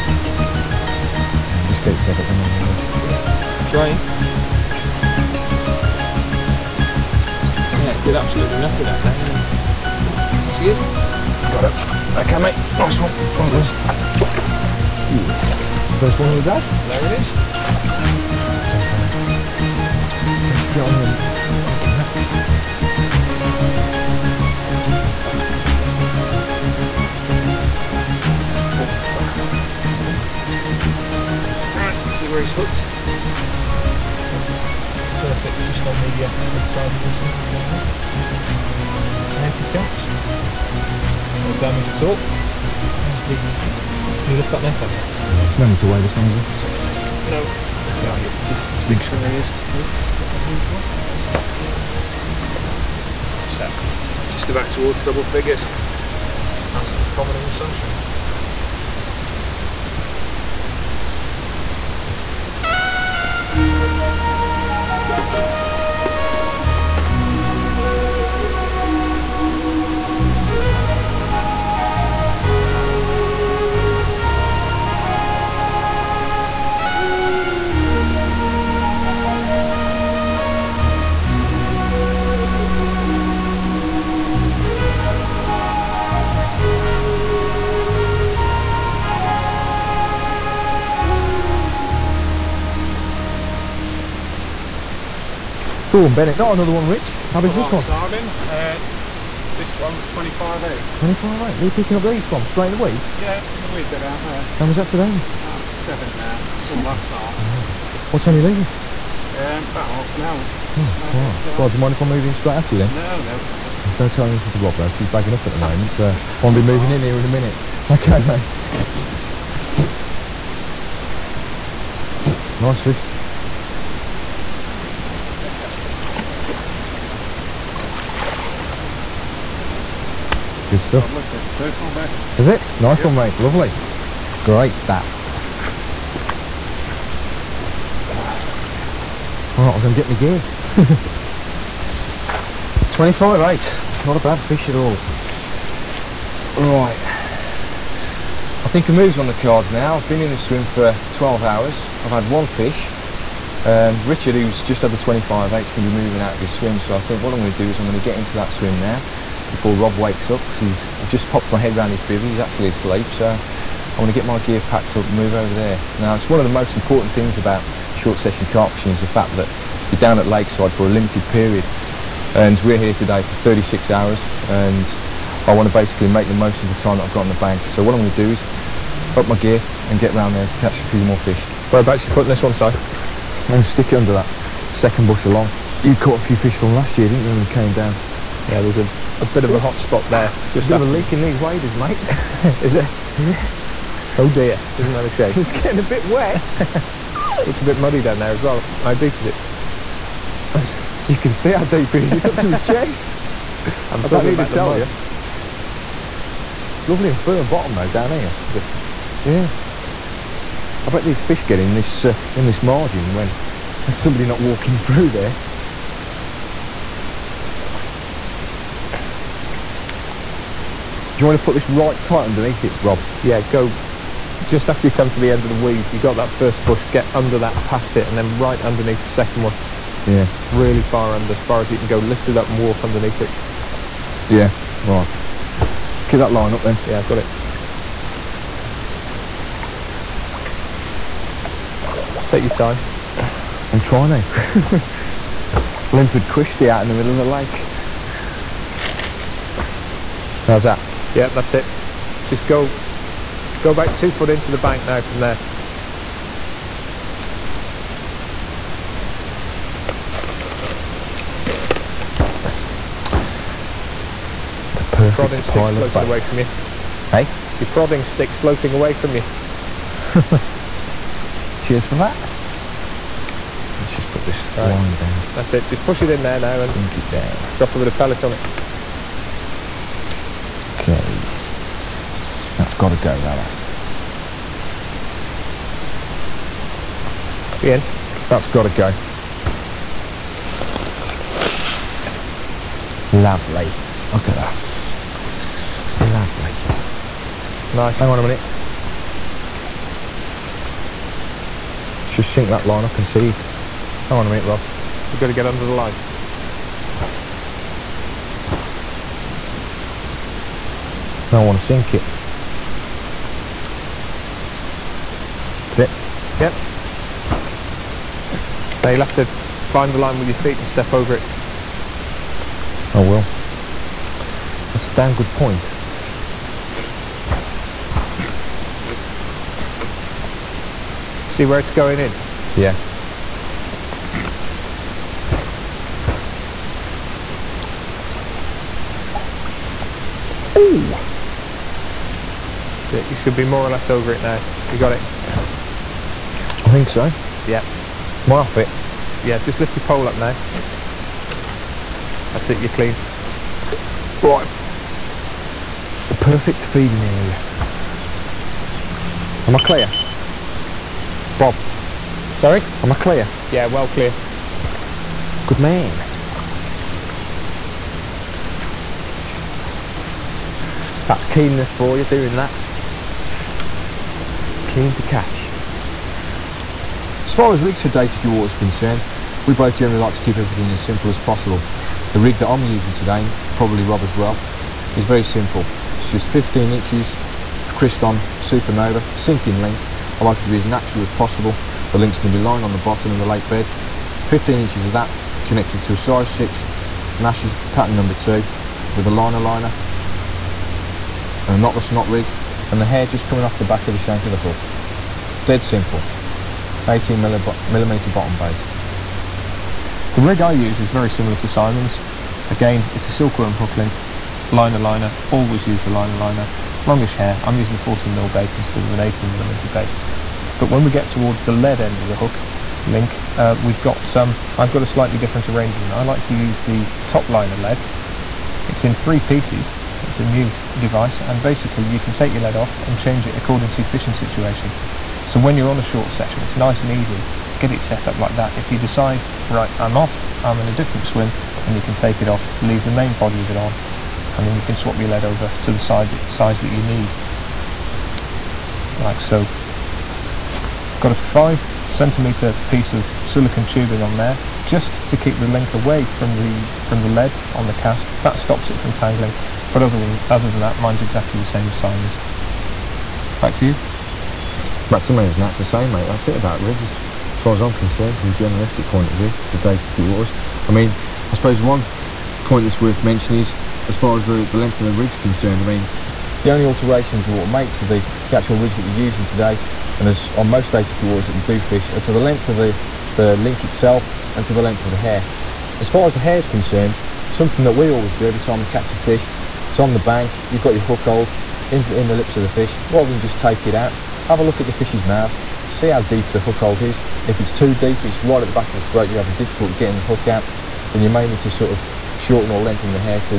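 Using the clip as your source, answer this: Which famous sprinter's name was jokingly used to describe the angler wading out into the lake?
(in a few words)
Linford Christie.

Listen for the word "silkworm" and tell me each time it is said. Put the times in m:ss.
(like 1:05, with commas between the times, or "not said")
6:53.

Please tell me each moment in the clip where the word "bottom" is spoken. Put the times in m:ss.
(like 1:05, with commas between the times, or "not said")
3:27, 6:32, 6:48.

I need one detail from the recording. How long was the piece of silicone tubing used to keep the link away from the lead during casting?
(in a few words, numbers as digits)
5 centimetres.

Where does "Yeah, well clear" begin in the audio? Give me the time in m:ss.
6:03.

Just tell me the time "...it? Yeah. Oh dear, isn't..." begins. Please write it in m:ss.
3:12.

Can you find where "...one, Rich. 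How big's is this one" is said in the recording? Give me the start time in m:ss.
1:36.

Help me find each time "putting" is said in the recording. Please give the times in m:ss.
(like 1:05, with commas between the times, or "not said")
3:02.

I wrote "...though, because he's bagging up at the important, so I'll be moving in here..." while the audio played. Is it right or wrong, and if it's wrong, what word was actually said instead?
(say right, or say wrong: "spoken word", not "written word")
wrong: "moment", not "important".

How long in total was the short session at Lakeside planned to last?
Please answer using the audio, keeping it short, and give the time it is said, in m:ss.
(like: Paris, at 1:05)
36 hours, at 2:53.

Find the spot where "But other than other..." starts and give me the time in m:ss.
7:39.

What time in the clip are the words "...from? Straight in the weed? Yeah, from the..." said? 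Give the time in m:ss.
1:42.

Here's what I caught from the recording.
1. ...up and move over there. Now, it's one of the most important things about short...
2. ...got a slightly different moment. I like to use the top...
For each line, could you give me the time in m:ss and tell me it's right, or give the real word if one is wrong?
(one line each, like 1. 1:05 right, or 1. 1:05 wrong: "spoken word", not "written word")
1. 2:44 right
2. 7:04 wrong: "arrangement", not "moment".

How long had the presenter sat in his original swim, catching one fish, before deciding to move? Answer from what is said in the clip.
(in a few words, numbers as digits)
12 hours.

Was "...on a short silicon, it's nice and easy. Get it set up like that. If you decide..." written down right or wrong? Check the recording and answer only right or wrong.
wrong.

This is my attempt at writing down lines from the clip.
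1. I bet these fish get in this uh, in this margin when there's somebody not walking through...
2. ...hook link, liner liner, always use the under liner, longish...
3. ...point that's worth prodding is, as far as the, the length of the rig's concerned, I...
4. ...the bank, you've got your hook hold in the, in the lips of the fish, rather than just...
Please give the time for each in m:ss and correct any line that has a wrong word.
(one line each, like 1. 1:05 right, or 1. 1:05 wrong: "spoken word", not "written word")
1. 3:30 right
2. 6:53 wrong: "liner", not "under"
3. 7:52 wrong: "mentioning", not "prodding"
4. 8:09 right.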